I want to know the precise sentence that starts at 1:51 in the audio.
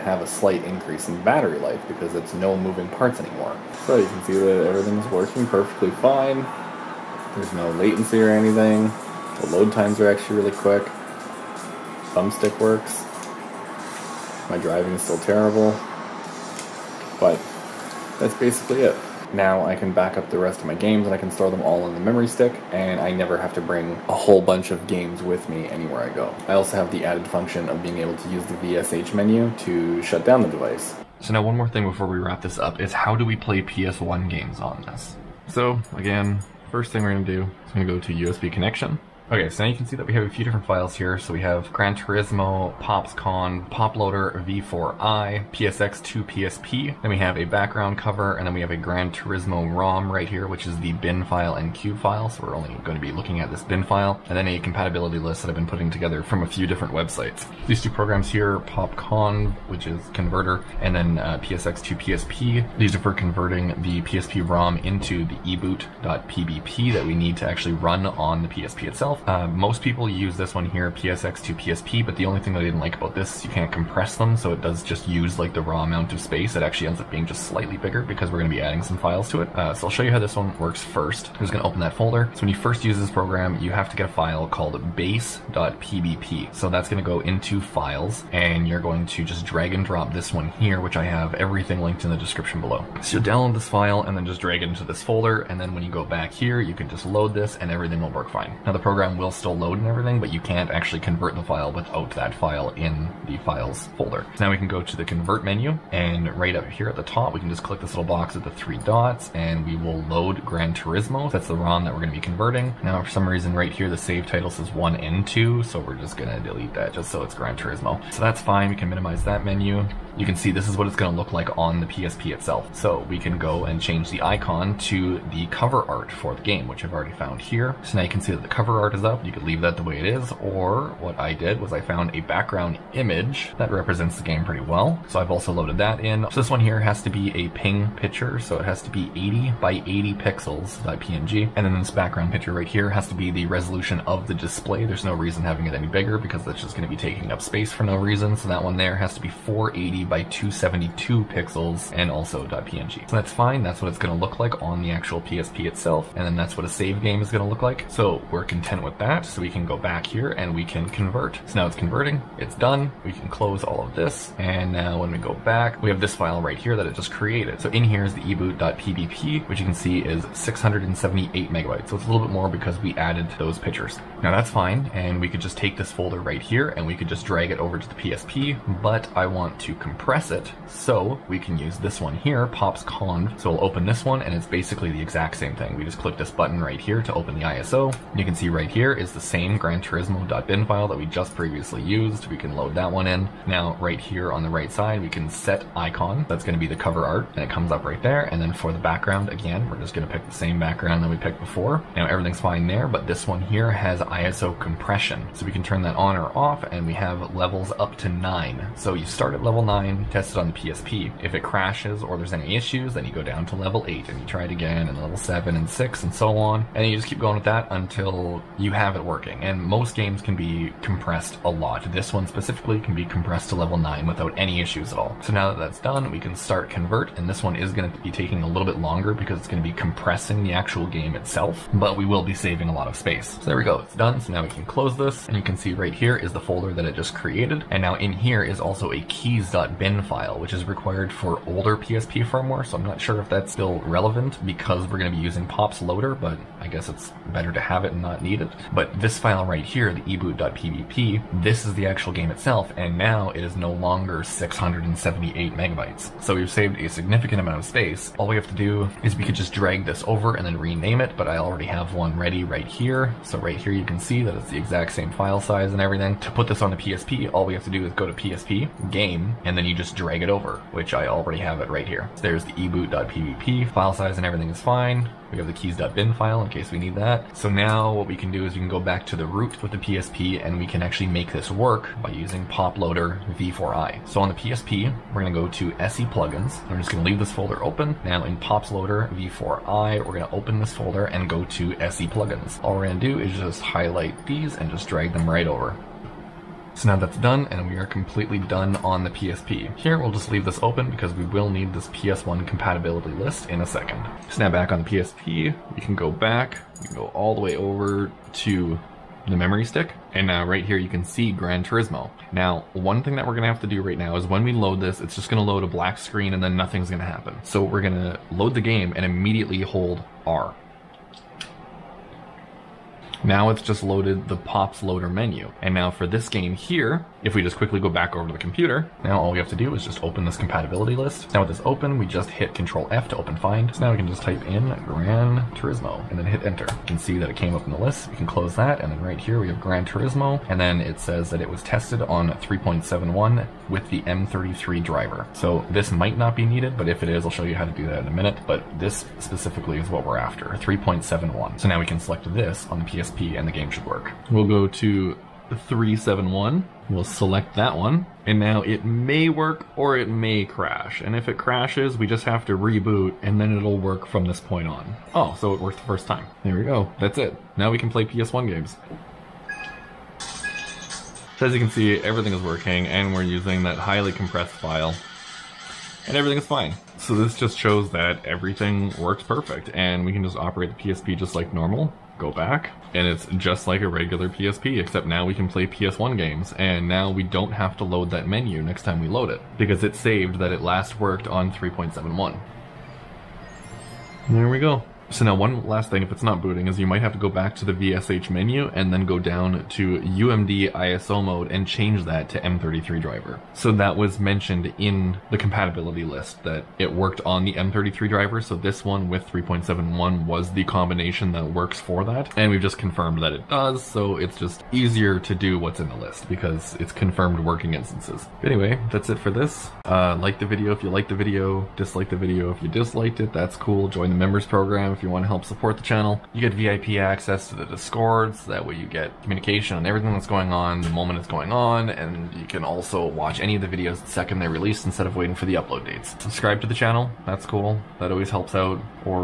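That's the ROM that we're going to be converting.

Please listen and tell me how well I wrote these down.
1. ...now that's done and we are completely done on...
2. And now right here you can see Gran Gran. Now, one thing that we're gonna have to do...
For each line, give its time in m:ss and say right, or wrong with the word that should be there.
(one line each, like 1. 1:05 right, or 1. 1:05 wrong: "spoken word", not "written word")
1. 4:56 right
2. 5:10 wrong: "Turismo", not "Gran".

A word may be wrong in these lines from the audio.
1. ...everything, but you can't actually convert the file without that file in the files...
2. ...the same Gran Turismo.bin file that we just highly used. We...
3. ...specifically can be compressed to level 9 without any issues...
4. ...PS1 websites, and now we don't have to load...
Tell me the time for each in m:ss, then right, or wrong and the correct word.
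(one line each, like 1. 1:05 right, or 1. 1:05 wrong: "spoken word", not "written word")
1. 1:39 right
2. 3:09 wrong: "previously", not "highly"
3. 3:42 right
4. 6:25 wrong: "games", not "websites".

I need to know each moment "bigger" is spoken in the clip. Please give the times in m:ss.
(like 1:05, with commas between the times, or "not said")
1:17, 2:25.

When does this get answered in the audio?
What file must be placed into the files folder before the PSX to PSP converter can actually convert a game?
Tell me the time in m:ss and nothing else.
1:24.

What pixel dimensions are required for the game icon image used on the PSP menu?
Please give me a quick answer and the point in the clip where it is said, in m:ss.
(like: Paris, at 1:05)
80 by 80, at 2:19.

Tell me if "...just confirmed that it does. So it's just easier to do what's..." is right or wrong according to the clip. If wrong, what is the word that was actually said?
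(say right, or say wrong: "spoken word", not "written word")
right.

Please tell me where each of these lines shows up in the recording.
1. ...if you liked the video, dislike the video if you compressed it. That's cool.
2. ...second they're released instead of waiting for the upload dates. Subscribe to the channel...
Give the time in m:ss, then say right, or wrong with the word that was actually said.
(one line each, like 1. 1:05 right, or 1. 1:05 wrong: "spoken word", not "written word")
1. 7:00 wrong: "disliked", not "compressed"
2. 7:14 right.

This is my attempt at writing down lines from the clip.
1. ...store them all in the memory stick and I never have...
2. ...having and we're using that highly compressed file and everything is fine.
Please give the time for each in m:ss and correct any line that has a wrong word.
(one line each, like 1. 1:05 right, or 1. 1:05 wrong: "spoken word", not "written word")
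1. 0:21 right
2. 6:12 wrong: "working", not "having".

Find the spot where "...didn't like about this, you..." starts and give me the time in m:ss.
1:12.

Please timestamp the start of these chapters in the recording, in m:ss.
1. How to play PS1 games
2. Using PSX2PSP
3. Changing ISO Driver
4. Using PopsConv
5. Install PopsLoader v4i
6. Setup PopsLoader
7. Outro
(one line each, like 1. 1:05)
1. 0:31
2. 1:20
3. 6:35
4. 2:59
5. 4:37
6. 5:04
7. 6:58.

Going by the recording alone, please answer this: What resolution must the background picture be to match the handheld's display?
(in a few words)
480 by 272.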